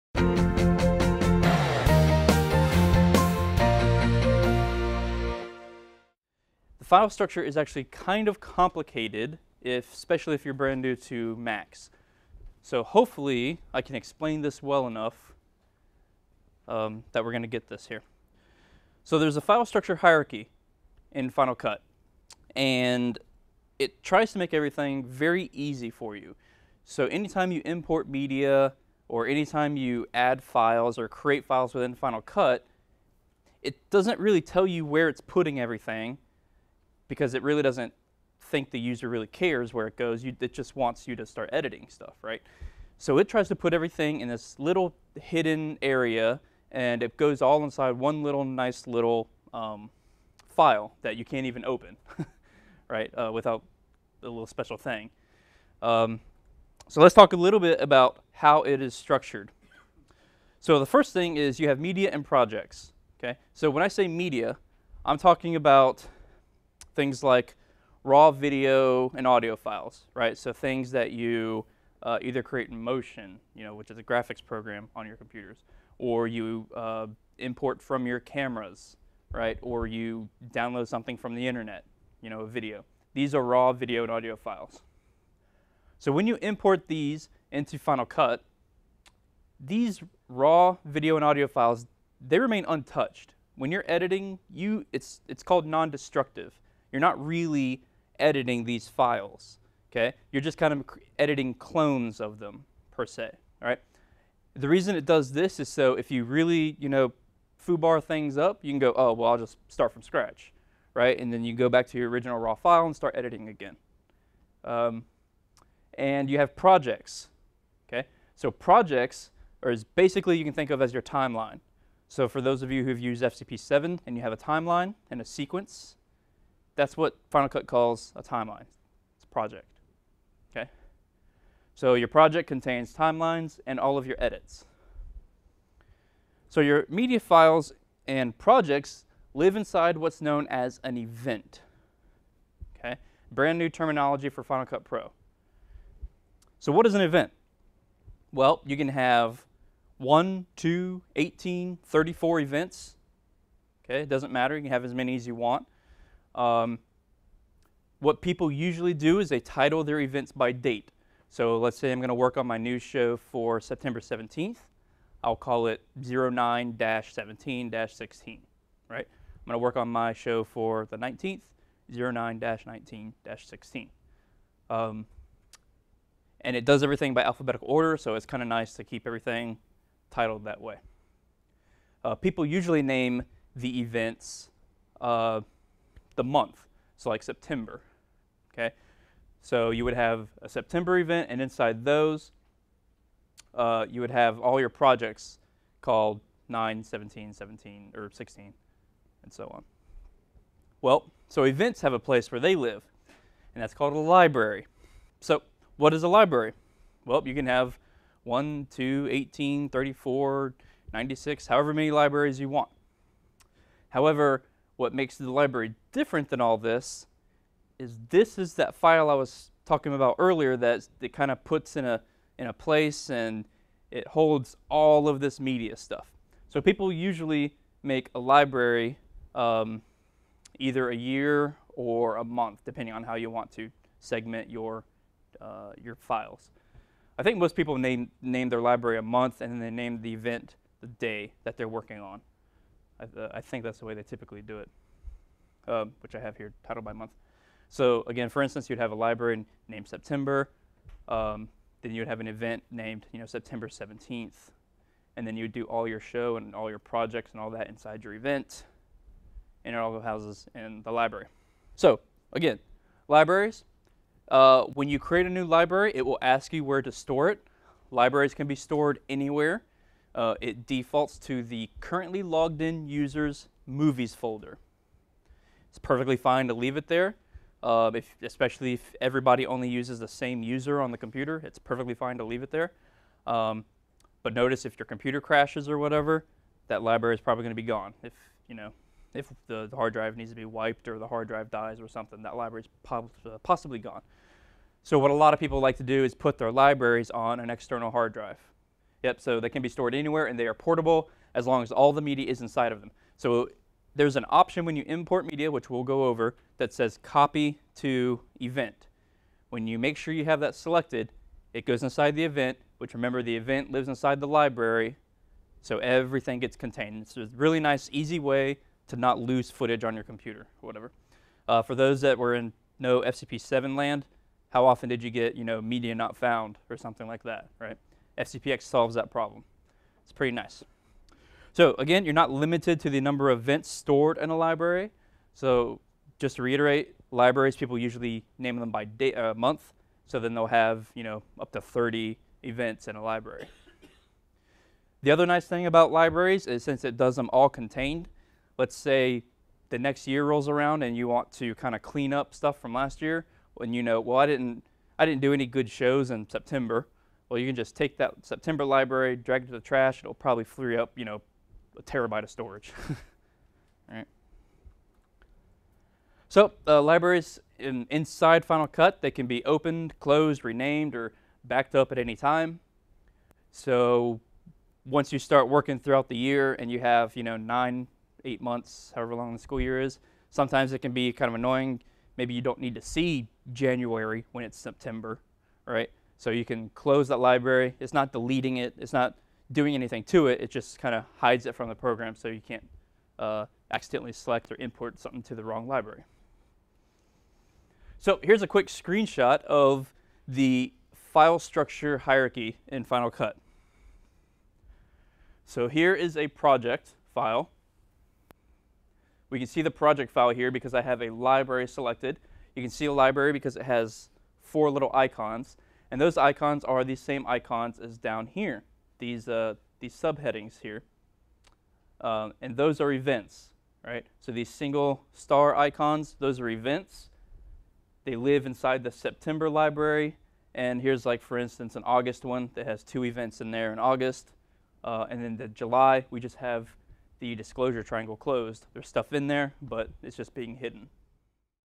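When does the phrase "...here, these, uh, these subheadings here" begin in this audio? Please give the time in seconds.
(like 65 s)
418 s.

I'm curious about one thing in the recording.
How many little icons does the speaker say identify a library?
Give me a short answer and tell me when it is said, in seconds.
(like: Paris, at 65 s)
4, at 414 s.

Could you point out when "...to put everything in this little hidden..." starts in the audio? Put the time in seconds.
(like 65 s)
43 s.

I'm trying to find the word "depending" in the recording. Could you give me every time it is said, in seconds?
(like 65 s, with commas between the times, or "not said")
232 s.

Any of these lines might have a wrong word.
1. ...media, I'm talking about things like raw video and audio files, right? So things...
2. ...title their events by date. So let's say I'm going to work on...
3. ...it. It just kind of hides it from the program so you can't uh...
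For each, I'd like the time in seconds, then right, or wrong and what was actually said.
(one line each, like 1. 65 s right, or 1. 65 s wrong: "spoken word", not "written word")
1. 64 s right
2. 159 s right
3. 390 s right.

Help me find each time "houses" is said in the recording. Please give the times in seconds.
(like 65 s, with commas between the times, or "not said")
259 s.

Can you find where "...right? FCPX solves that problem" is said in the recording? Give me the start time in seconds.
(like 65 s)
327 s.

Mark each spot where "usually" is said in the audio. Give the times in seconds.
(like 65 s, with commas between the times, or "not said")
158 s, 182 s, 226 s, 337 s.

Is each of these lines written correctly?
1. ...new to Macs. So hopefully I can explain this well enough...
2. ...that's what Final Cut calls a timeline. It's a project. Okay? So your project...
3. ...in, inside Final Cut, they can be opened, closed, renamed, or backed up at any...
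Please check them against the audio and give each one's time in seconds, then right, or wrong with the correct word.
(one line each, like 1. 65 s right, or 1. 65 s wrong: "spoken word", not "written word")
1. 10 s right
2. 126 s right
3. 367 s right.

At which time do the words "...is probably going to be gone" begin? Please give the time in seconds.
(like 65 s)
287 s.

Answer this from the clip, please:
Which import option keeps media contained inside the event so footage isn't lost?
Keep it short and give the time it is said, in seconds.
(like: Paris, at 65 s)
copy to event, at 307 s.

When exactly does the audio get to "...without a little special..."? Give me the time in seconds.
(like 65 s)
53 s.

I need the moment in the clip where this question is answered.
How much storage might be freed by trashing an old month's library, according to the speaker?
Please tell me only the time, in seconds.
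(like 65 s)
361 s.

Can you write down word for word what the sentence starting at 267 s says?
Libraries can be stored anywhere uh, it defaults to the currently logged in user's movies folder.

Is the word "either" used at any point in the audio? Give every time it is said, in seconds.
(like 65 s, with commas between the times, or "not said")
72 s, 230 s.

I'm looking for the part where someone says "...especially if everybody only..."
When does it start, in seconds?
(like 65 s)
278 s.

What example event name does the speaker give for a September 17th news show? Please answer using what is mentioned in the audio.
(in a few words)
09-17-16.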